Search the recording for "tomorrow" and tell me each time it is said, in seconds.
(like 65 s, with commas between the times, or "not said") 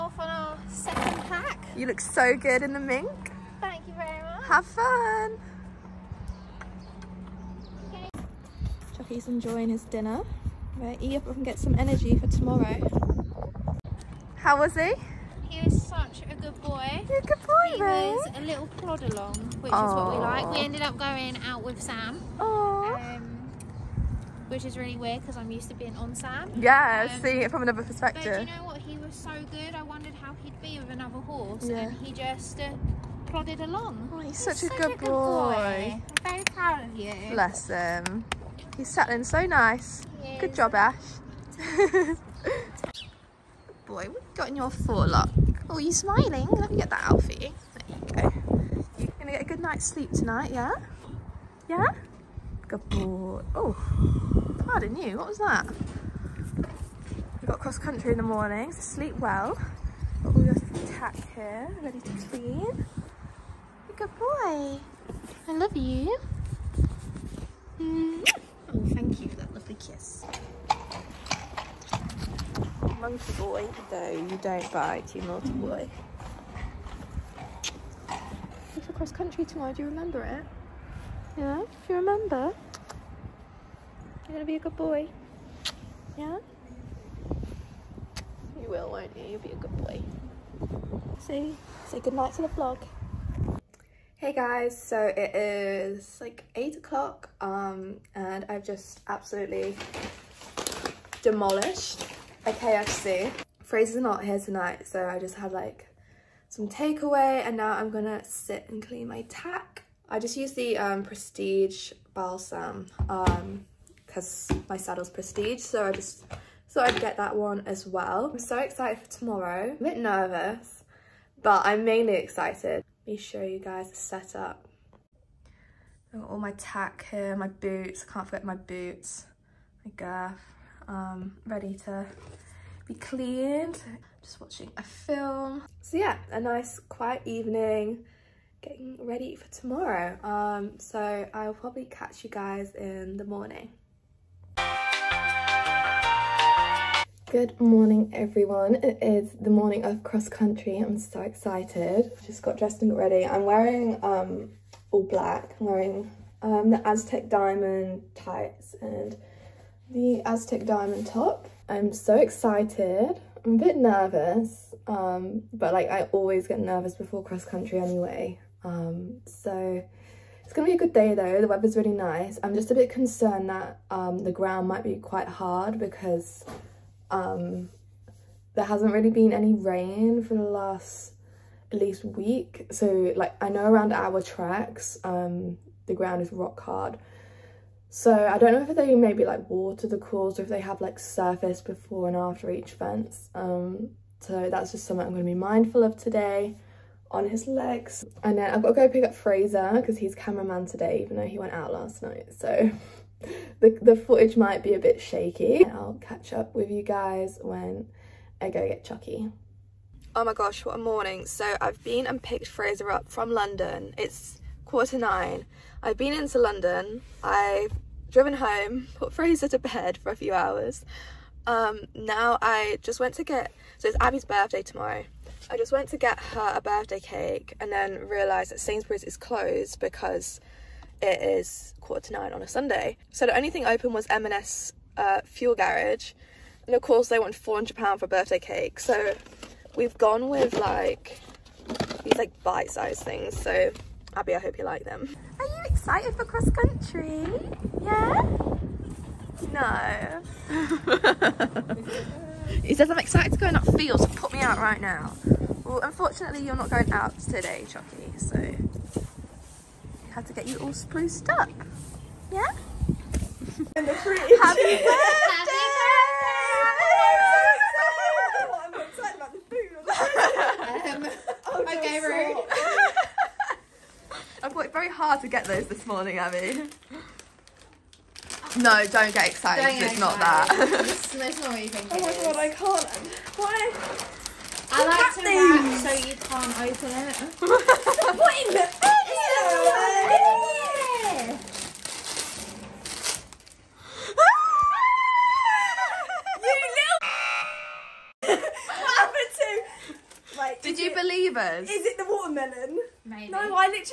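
12 s, 79 s, 119 s, 139 s, 224 s.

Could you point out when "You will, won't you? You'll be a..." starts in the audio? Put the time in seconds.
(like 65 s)
88 s.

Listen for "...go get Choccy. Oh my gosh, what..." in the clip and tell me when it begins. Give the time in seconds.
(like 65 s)
208 s.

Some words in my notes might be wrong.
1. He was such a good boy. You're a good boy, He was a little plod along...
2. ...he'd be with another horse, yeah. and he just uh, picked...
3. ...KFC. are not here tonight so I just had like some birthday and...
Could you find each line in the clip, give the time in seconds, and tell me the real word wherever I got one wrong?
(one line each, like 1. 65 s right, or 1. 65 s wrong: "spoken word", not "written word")
1. 15 s right
2. 30 s wrong: "plodded", not "picked"
3. 102 s wrong: "takeaway", not "birthday".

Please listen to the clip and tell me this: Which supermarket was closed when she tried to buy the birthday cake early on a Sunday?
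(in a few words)
Sainsbury's.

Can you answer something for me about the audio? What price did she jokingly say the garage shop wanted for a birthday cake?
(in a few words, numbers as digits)
£400.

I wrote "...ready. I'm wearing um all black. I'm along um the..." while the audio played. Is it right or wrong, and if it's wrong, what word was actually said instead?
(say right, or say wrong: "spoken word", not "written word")
wrong: "wearing", not "along".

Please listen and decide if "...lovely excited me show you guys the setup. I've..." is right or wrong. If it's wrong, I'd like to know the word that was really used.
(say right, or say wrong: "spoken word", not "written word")
wrong: "mainly", not "lovely".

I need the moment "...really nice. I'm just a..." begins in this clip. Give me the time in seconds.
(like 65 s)
171 s.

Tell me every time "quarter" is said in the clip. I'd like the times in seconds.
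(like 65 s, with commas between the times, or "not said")
214 s, 231 s.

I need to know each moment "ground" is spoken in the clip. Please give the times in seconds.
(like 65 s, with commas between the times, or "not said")
174 s, 185 s.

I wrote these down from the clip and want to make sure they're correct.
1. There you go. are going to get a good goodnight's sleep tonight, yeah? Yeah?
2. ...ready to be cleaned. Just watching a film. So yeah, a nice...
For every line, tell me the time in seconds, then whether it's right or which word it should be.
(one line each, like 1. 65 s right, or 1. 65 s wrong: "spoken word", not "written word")
1. 47 s wrong: "night", not "goodnight"
2. 131 s right.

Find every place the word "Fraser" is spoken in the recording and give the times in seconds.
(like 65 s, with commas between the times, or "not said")
199 s, 212 s, 219 s.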